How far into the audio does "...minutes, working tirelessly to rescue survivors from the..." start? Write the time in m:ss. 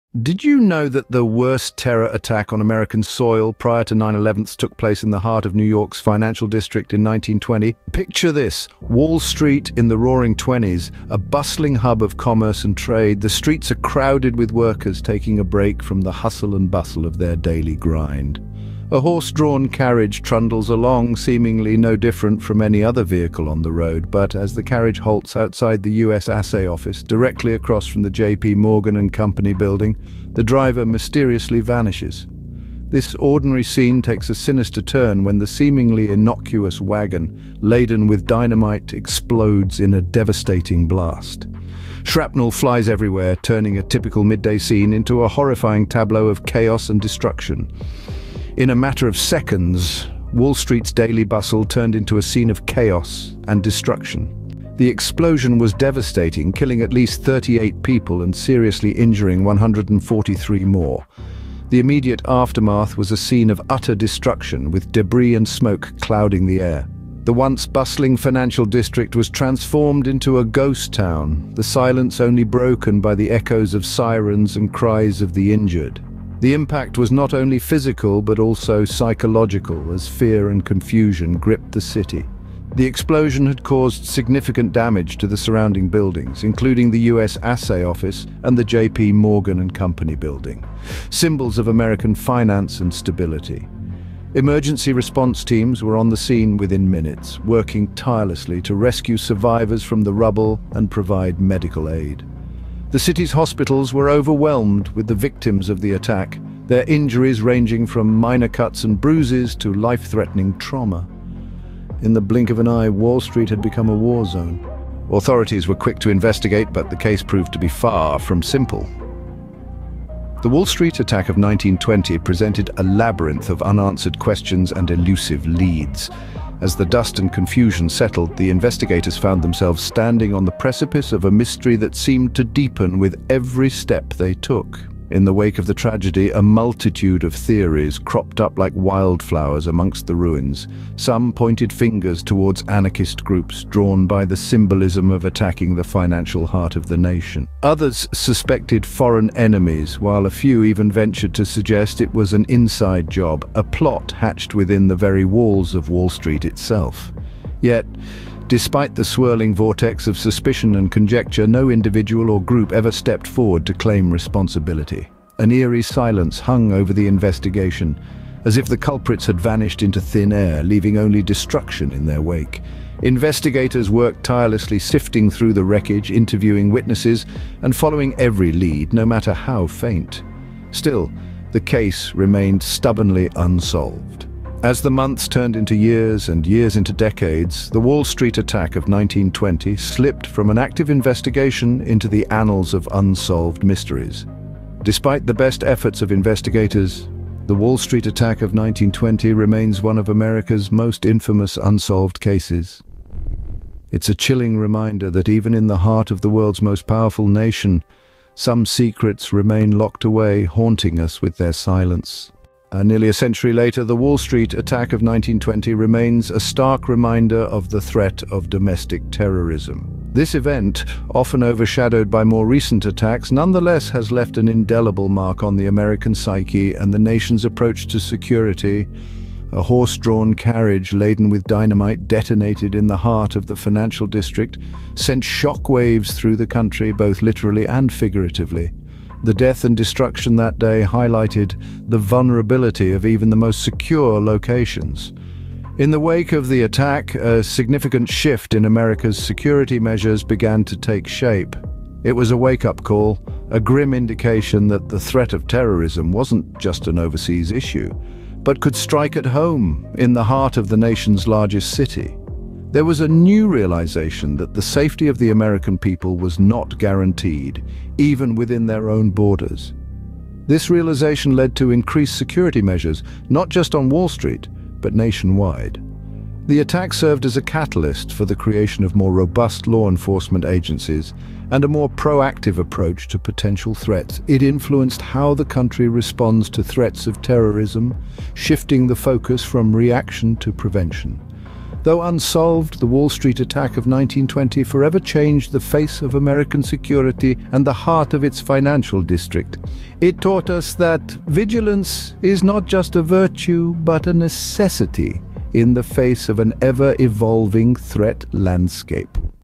1:36.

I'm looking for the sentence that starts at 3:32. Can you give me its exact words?
Uh, nearly a century later, the Wall Street attack of 1920 remains a stark reminder of the threat of domestic terrorism.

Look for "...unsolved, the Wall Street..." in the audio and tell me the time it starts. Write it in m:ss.
4:52.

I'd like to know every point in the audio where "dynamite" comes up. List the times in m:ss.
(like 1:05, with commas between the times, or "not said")
0:38, 3:51.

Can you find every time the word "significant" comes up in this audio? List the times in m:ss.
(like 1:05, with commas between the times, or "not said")
1:24, 4:07.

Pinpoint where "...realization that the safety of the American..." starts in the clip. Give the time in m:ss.
4:23.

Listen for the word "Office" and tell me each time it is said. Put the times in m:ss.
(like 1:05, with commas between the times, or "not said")
0:26, 1:27.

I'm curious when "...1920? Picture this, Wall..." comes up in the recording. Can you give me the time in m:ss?
0:07.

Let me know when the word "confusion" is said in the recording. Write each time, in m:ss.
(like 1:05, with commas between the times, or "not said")
1:20, 2:07.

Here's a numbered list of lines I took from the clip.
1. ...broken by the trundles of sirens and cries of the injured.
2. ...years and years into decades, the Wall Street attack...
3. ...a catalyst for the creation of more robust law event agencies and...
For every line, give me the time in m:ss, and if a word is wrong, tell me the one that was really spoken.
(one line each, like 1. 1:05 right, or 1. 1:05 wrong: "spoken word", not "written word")
1. 1:12 wrong: "echoes", not "trundles"
2. 3:05 right
3. 4:37 wrong: "enforcement", not "event".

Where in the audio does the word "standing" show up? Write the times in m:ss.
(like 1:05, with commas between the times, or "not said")
2:09.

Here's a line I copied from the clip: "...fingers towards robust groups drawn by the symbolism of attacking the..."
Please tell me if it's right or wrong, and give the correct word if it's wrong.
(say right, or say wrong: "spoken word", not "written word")
wrong: "anarchist", not "robust".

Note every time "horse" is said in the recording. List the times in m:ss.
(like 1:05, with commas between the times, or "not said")
0:18, 3:49.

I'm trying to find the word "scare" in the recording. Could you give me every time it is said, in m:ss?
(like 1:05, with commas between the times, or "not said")
not said.